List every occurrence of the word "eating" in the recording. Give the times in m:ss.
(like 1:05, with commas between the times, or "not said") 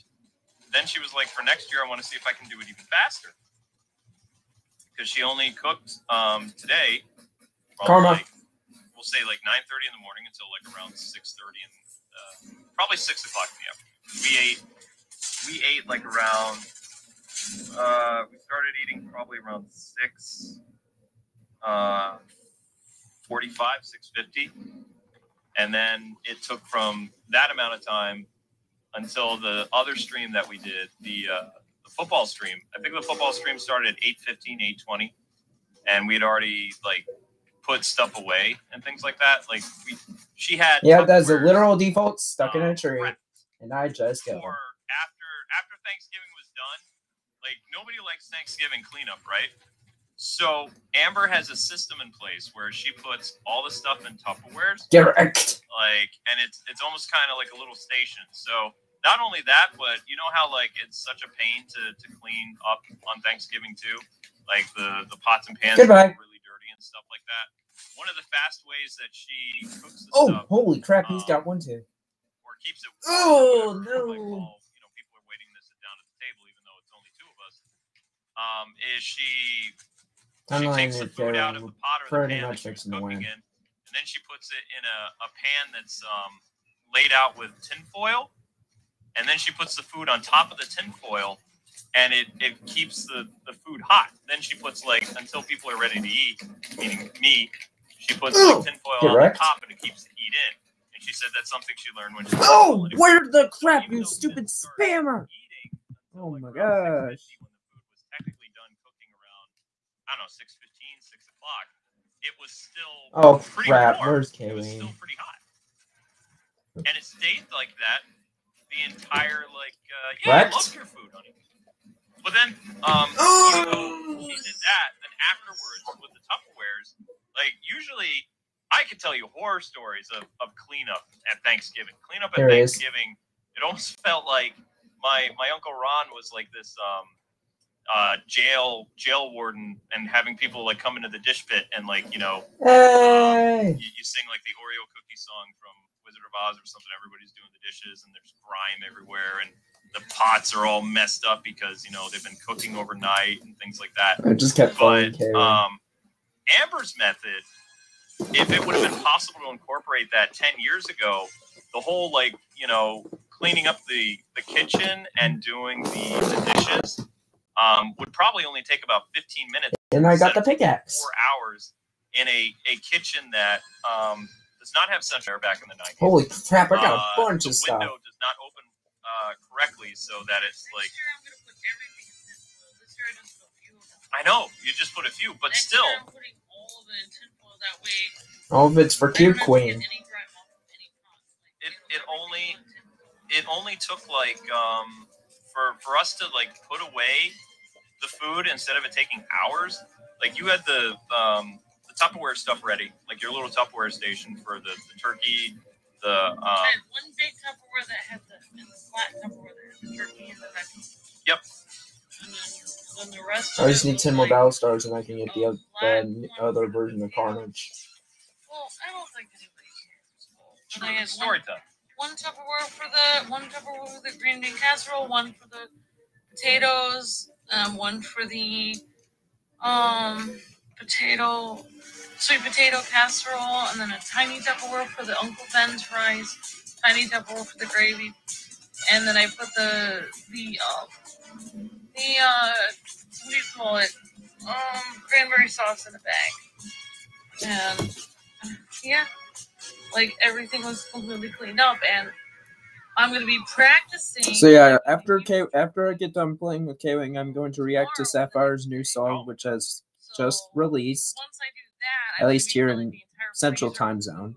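0:18, 1:45.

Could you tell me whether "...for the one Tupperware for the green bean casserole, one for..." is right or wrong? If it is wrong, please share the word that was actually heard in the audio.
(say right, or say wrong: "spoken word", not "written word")
right.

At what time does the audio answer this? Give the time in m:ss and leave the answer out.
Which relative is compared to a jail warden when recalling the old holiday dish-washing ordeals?
2:15.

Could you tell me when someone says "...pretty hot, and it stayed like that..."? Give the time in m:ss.
1:54.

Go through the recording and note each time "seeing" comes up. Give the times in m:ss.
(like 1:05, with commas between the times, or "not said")
not said.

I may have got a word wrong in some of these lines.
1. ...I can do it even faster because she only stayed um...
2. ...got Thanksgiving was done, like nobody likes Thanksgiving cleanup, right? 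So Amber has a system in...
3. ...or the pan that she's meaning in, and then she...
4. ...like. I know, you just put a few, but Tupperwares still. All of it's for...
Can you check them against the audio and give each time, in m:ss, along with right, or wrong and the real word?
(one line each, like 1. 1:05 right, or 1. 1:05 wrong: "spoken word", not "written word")
1. 0:02 wrong: "cooked", not "stayed"
2. 0:44 right
3. 1:22 wrong: "cooking", not "meaning"
4. 3:00 wrong: "Next", not "Tupperwares".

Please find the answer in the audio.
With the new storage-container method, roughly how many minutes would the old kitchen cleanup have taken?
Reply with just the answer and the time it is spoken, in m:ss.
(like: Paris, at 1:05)
15 minutes, at 2:49.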